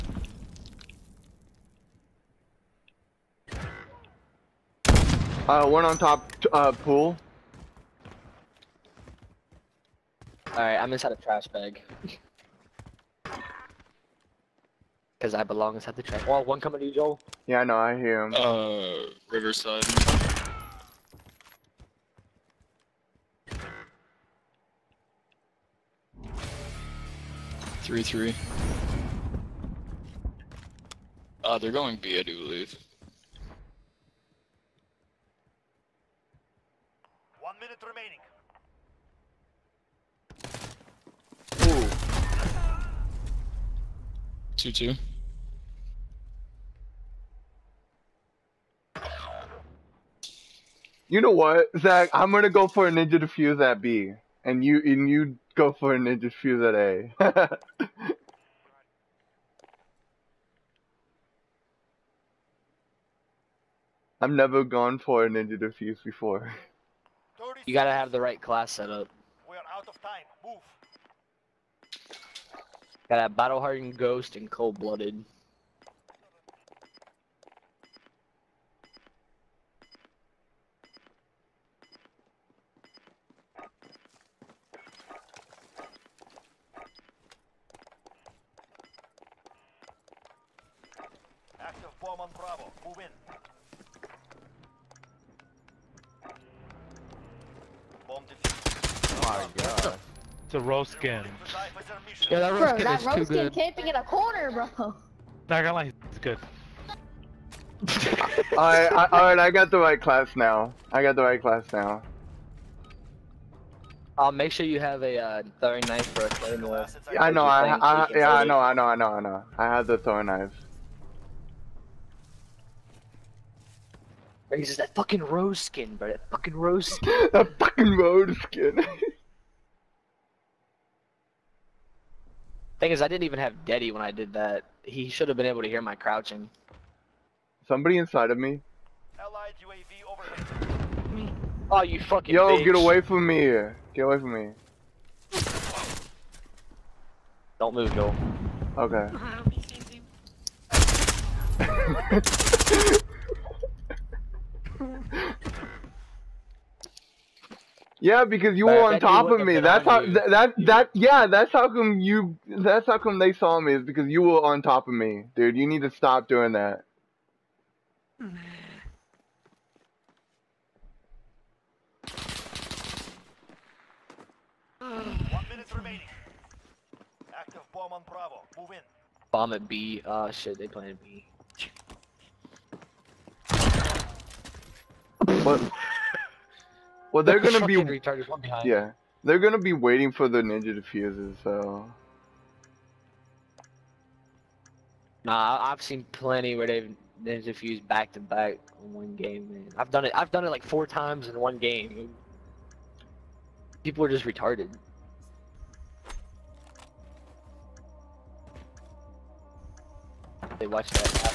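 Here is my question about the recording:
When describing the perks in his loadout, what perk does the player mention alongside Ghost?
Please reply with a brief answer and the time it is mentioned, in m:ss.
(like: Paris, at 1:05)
Battle Hardened, at 1:13.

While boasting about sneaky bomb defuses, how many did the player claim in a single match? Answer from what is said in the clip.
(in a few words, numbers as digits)
4.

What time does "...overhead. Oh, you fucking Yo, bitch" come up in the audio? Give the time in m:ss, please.
2:20.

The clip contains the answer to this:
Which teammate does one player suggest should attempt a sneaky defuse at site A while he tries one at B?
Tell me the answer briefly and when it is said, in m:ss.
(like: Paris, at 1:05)
Zach, at 0:51.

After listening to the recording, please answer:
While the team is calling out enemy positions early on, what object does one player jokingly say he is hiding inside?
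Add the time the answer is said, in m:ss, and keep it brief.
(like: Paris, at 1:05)
Trash bag, at 0:11.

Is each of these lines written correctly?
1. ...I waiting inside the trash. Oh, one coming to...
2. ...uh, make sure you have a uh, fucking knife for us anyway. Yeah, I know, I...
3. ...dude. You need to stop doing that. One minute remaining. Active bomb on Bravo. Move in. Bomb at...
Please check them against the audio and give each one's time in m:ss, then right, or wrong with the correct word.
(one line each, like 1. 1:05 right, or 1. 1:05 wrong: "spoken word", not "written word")
1. 0:15 wrong: "belong", not "waiting"
2. 1:54 wrong: "throwing", not "fucking"
3. 2:45 right.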